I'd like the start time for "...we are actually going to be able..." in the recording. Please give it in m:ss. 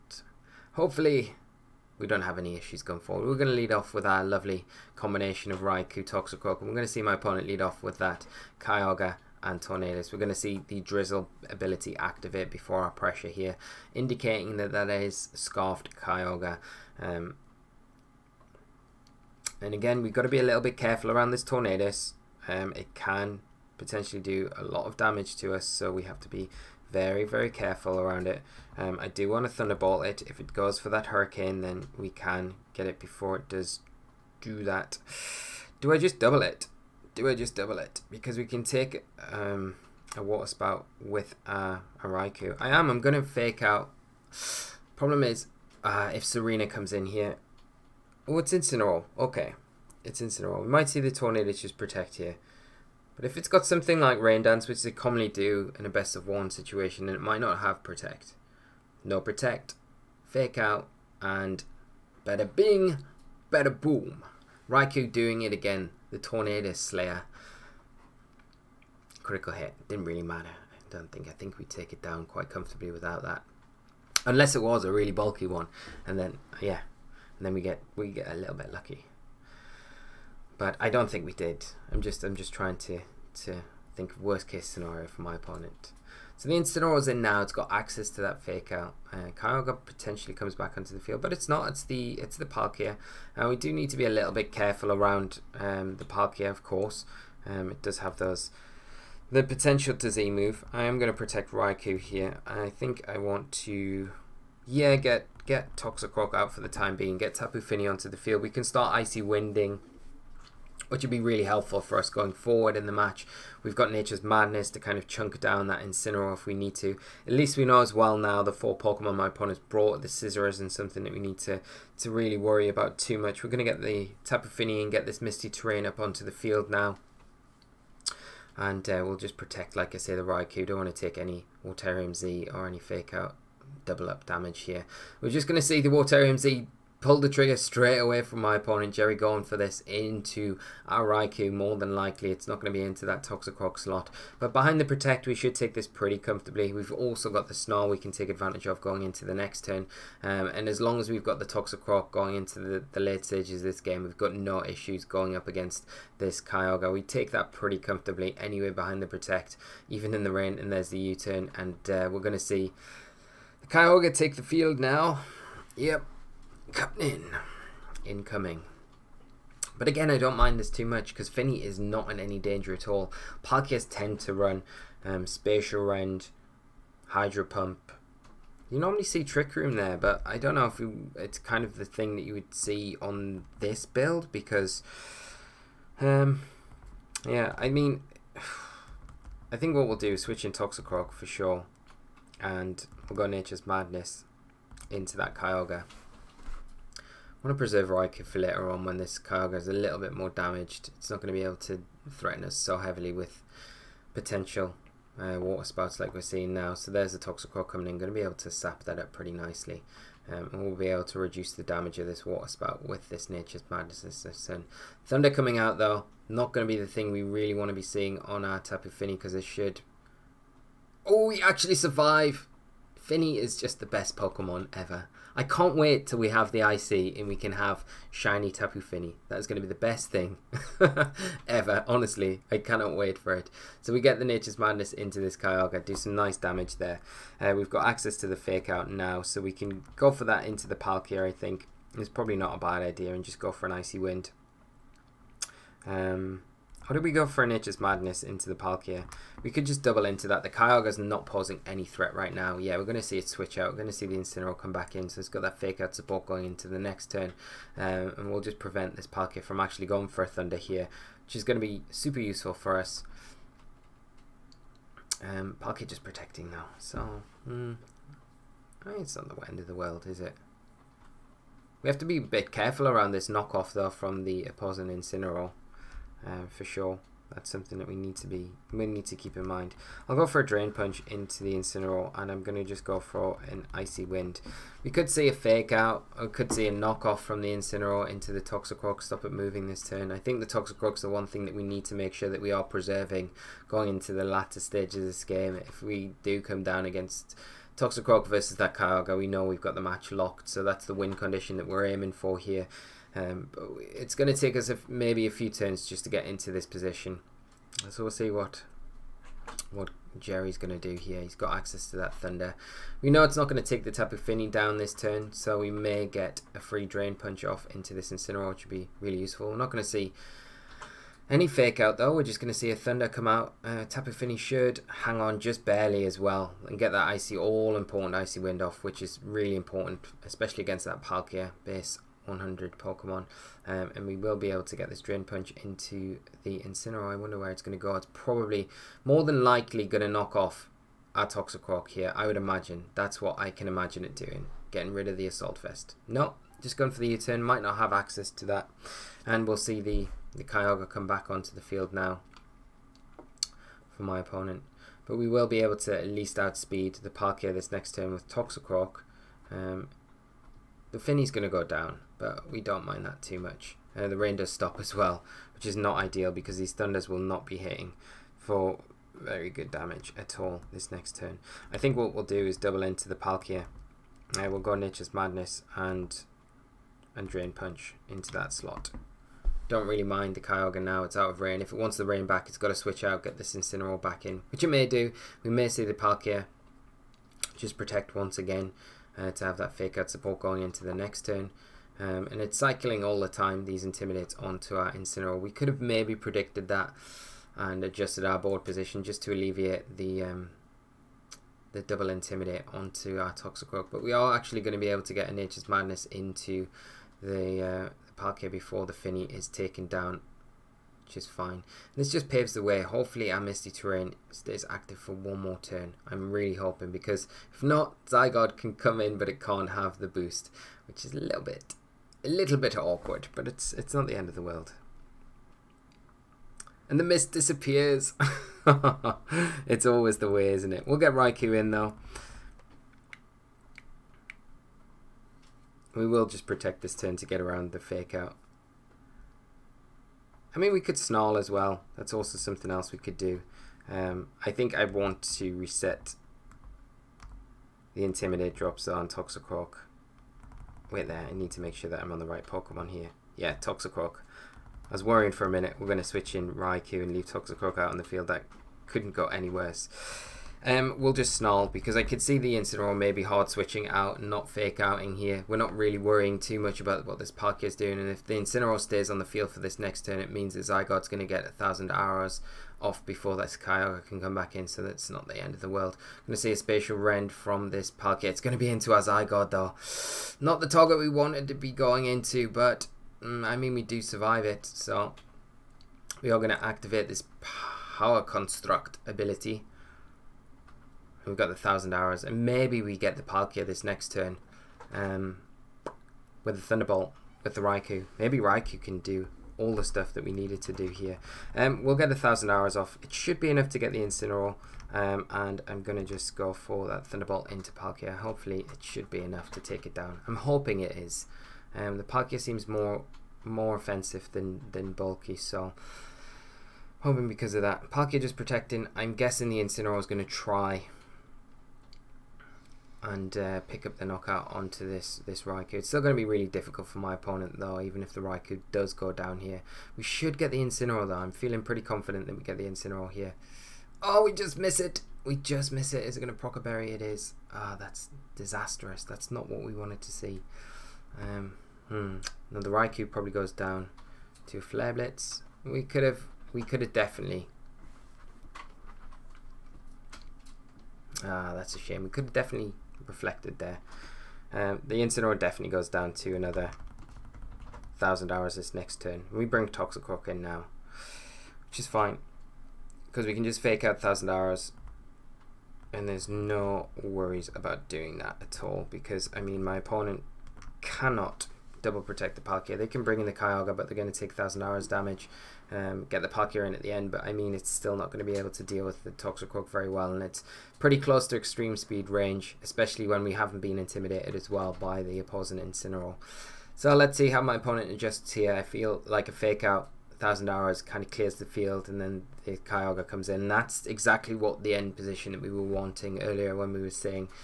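6:44.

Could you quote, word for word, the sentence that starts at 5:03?
Um, but it's going to take us a, maybe a few turns just to get into this position.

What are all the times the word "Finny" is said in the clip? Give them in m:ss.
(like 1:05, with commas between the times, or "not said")
2:51, 3:42, 6:00, 6:48.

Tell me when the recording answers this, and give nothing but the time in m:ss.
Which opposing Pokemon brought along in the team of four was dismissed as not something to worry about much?
2:00.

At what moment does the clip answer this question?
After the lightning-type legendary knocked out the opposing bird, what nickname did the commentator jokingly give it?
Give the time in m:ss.
1:06.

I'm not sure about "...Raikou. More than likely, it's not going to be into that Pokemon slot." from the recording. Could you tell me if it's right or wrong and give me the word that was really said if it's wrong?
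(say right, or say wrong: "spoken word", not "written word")
wrong: "Toxicroak", not "Pokemon".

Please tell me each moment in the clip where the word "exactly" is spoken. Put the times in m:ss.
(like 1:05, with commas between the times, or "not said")
9:53.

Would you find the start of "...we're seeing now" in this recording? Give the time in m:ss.
3:26.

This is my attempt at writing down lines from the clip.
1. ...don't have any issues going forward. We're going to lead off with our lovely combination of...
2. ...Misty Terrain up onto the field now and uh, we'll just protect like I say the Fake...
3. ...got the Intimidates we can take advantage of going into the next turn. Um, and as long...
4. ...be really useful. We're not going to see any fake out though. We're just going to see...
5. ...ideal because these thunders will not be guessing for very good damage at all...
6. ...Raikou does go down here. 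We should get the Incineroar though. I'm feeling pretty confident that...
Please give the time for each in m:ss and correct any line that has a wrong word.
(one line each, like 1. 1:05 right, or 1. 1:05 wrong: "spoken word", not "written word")
1. 0:02 right
2. 2:05 wrong: "Raikou", not "Fake"
3. 2:27 wrong: "Snarl", not "Intimidates"
4. 5:18 right
5. 6:05 wrong: "hitting", not "guessing"
6. 8:48 right.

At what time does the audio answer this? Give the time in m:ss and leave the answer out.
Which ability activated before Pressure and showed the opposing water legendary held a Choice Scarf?
0:10.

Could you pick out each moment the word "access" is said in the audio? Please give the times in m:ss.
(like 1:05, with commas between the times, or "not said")
1:27, 3:57, 5:11, 5:47.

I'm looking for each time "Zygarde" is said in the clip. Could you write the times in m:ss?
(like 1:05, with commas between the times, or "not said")
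6:58, 7:50, 7:59.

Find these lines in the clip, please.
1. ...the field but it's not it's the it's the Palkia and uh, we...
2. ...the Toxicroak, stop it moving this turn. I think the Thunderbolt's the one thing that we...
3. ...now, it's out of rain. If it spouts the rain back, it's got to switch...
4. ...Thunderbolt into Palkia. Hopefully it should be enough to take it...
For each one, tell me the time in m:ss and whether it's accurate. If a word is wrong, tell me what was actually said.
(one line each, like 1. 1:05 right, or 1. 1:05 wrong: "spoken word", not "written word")
1. 1:30 right
2. 4:48 wrong: "Toxicroak", not "Thunderbolt"
3. 6:20 wrong: "wants", not "spouts"
4. 8:27 right.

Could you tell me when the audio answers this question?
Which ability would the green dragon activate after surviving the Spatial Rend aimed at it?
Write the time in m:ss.
8:07.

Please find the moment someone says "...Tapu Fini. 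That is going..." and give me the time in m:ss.
3:48.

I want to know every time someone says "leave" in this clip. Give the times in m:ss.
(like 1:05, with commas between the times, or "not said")
7:37.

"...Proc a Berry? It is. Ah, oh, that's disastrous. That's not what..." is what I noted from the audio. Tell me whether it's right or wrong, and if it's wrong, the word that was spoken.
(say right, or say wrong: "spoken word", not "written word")
right.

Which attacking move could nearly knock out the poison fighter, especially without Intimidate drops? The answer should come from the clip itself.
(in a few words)
Extreme Speed.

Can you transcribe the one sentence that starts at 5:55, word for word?
But we will be able to at least outspeed the Palkia this next turn with Toxicroak.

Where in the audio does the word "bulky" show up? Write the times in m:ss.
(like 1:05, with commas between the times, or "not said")
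1:15, 8:34.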